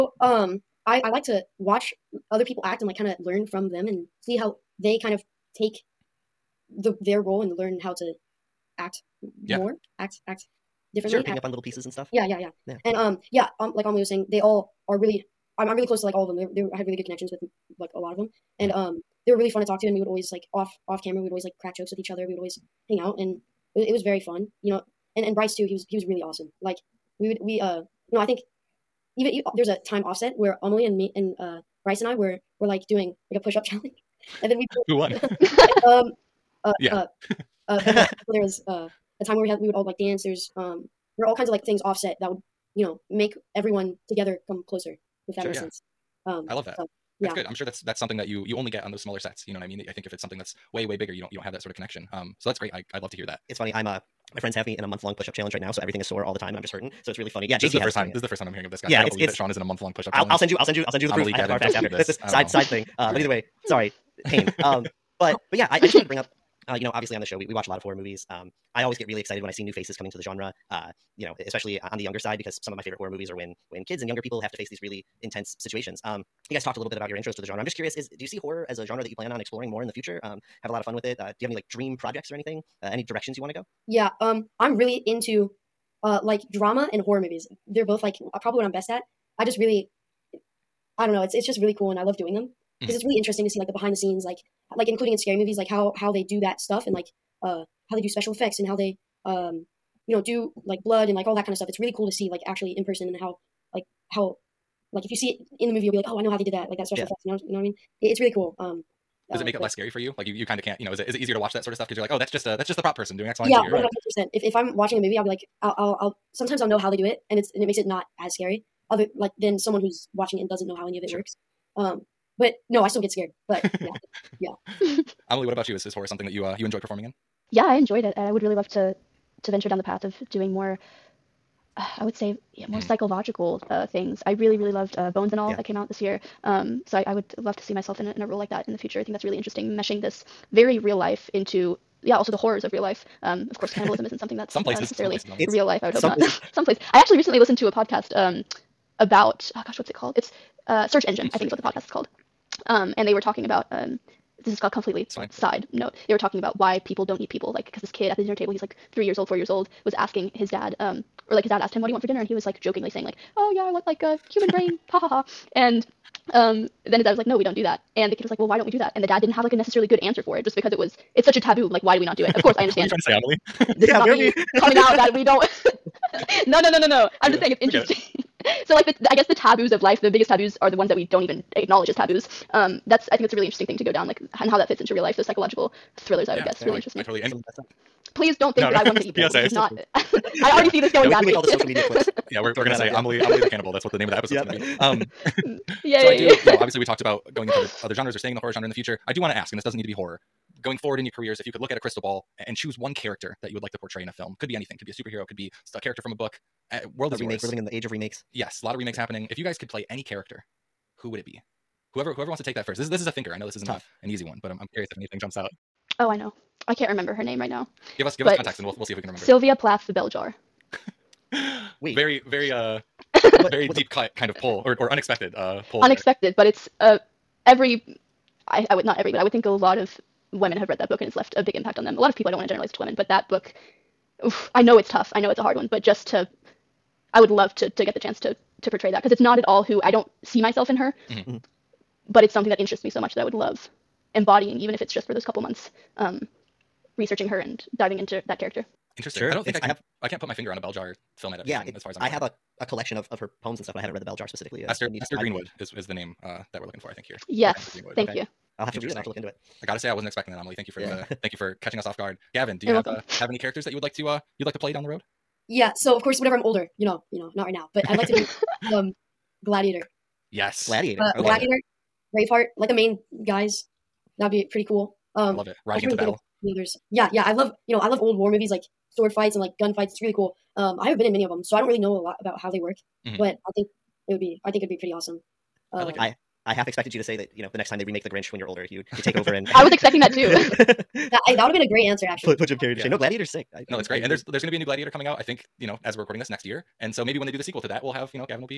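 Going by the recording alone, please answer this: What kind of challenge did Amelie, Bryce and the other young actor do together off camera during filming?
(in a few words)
push up challenge.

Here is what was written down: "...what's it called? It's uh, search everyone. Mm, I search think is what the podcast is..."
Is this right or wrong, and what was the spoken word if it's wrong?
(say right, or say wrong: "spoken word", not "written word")
wrong: "engine", not "everyone".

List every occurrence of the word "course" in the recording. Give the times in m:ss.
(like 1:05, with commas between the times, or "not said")
2:23, 2:52, 4:26.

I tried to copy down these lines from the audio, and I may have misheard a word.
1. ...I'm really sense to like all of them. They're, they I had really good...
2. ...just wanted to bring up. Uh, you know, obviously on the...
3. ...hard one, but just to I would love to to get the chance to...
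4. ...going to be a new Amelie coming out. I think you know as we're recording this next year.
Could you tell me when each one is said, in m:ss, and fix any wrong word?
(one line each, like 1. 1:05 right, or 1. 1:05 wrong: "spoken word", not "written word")
1. 0:15 wrong: "close", not "sense"
2. 1:05 right
3. 3:55 right
4. 4:54 wrong: "Gladiator", not "Amelie".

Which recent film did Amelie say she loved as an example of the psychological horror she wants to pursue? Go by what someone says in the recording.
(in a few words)
Bones and All.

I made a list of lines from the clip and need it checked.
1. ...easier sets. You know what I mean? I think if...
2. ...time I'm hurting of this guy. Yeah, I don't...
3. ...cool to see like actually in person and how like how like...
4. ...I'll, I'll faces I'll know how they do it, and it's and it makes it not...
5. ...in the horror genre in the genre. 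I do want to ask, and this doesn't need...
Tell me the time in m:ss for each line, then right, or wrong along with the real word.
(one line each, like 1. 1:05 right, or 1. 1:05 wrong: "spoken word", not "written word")
1. 0:49 wrong: "smaller", not "easier"
2. 0:58 wrong: "hearing", not "hurting"
3. 1:41 right
4. 1:55 wrong: "sometimes", not "faces"
5. 3:18 wrong: "future", not "genre".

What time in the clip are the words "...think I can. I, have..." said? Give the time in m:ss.
4:09.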